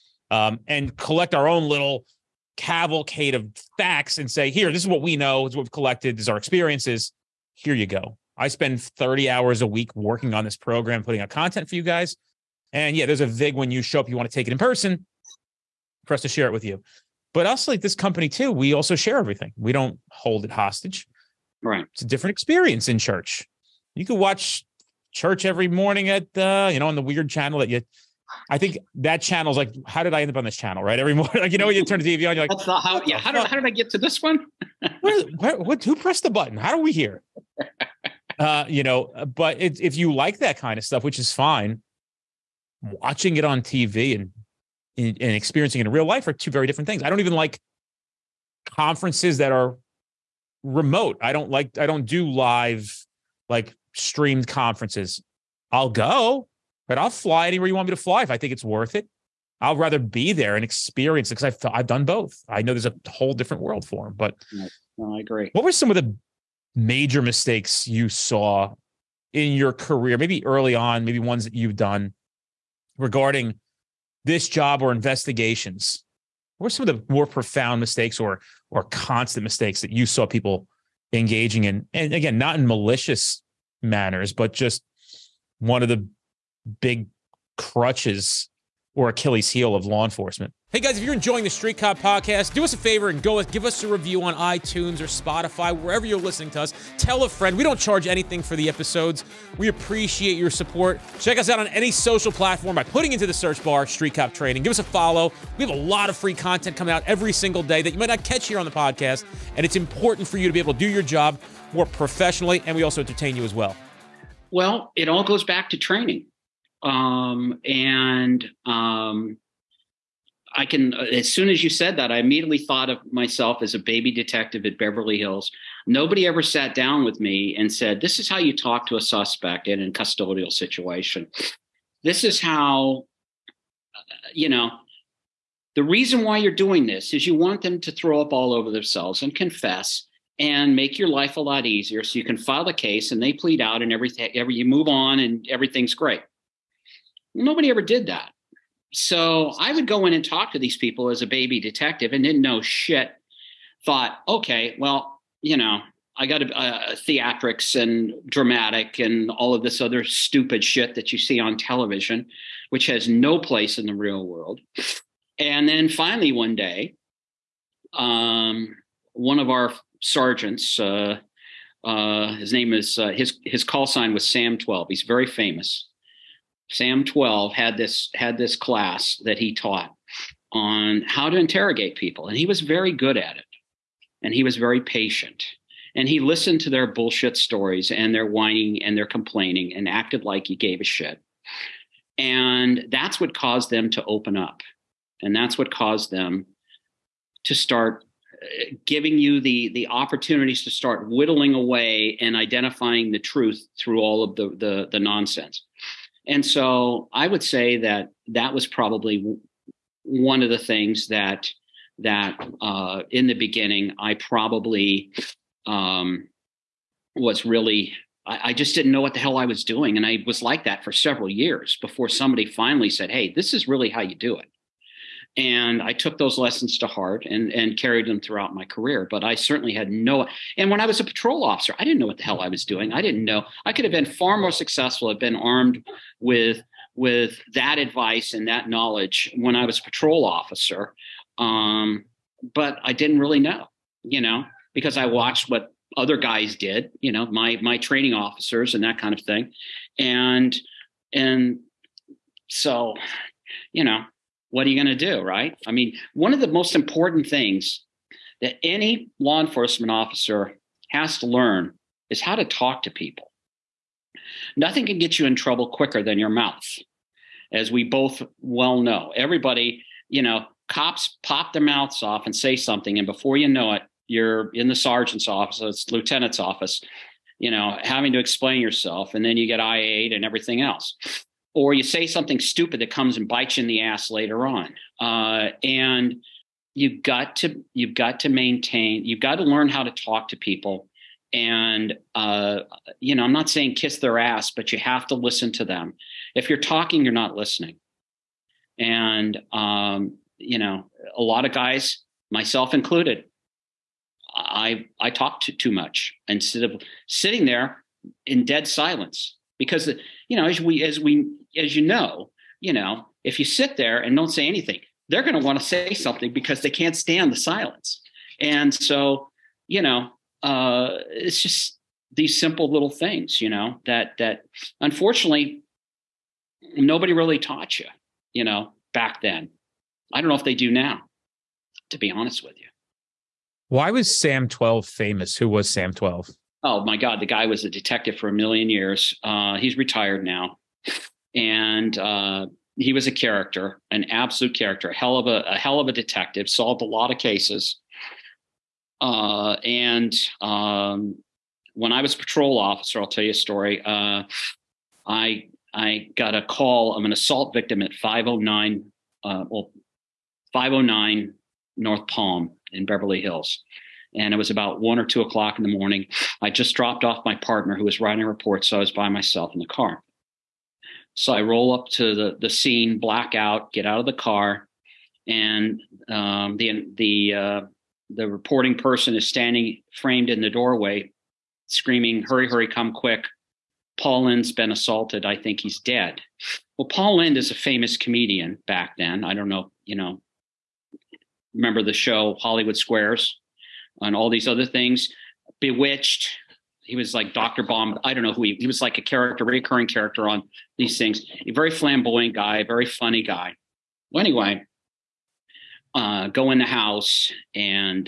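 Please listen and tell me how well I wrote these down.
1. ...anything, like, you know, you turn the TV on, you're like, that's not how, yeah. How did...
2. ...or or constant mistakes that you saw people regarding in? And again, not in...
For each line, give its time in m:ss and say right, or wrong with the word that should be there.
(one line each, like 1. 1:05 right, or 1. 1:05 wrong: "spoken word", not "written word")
1. 0:31 wrong: "morning", not "anything"
2. 1:18 wrong: "engaging", not "regarding".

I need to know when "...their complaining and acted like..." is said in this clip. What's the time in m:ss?
3:08.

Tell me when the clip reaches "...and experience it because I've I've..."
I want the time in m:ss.
1:00.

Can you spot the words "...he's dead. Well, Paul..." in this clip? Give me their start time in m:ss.
6:25.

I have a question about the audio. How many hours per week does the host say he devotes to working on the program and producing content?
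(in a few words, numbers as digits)
30.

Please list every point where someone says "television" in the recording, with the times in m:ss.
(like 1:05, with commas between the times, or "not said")
2:41.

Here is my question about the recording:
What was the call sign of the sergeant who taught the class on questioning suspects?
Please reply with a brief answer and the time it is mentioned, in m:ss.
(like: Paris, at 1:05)
Sam 12, at 2:54.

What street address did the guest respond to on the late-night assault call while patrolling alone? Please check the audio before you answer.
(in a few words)
509 North Palm.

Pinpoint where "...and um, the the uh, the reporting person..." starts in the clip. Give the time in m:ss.
6:15.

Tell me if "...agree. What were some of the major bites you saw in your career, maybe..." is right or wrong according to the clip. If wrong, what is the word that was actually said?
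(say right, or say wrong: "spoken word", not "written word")
wrong: "mistakes", not "bites".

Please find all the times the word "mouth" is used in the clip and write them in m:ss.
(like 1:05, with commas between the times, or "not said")
4:26, 4:31.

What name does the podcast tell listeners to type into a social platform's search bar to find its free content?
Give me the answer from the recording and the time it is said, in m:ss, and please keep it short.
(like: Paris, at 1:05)
Street Cop Training, at 1:43.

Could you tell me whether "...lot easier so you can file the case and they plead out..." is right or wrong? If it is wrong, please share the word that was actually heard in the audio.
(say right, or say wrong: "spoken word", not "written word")
right.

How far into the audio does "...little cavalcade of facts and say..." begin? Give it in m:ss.
0:01.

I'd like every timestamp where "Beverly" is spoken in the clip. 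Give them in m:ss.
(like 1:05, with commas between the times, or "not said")
2:04, 6:02.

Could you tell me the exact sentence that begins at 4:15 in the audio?
I mean, one of the most important things that any law enforcement officer has to learn is how to talk to people.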